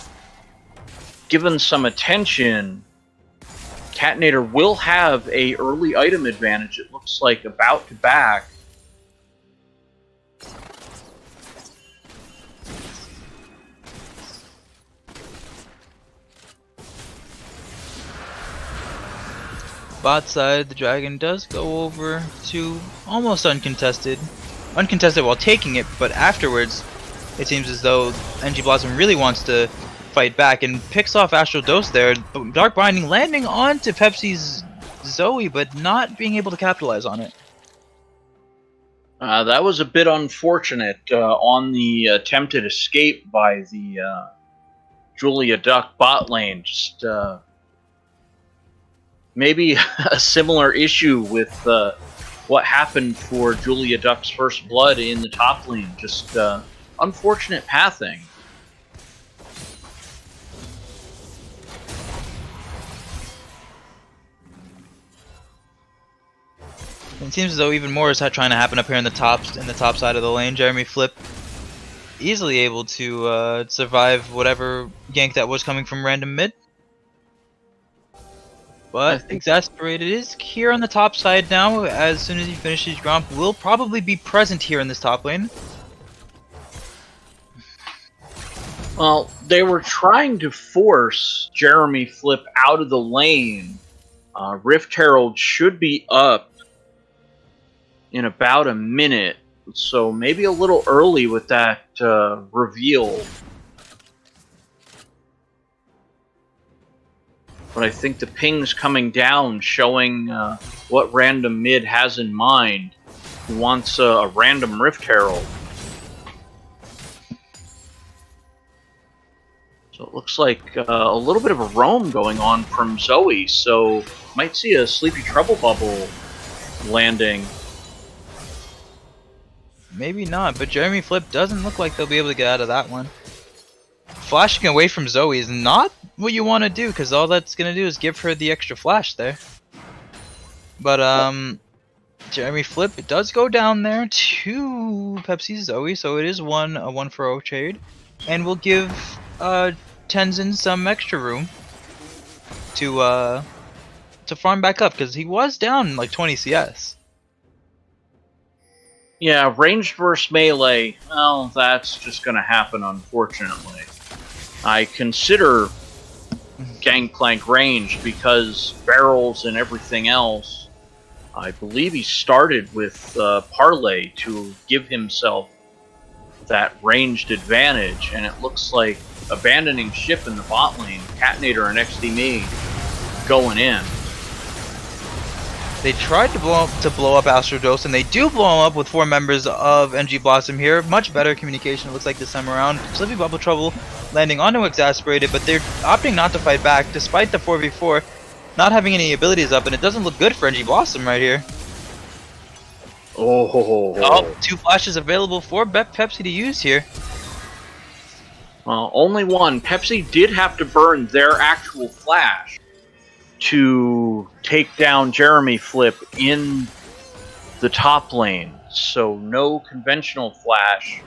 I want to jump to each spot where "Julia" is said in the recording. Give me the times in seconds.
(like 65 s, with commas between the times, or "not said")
45 s, 53 s.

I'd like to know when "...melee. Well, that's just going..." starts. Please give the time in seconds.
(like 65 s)
160 s.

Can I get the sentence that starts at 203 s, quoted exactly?
Oh, oh, two oh two flashes available for Pepsi to use here.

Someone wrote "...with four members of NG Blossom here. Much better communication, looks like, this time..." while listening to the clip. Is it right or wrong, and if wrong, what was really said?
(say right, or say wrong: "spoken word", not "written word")
right.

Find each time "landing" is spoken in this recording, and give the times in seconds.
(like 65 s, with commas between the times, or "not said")
33 s, 126 s, 194 s.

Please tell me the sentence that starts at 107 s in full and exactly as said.
But I think the ping's coming down, showing uh, what random mid has in mind.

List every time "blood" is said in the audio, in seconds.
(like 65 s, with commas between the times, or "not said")
54 s.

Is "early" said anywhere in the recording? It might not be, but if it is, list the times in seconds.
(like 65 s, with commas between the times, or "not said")
5 s, 100 s.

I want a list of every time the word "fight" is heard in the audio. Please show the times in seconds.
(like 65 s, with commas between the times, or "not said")
30 s, 196 s.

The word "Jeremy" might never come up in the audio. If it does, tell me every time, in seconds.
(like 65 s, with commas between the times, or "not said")
70 s, 91 s, 130 s, 142 s, 215 s.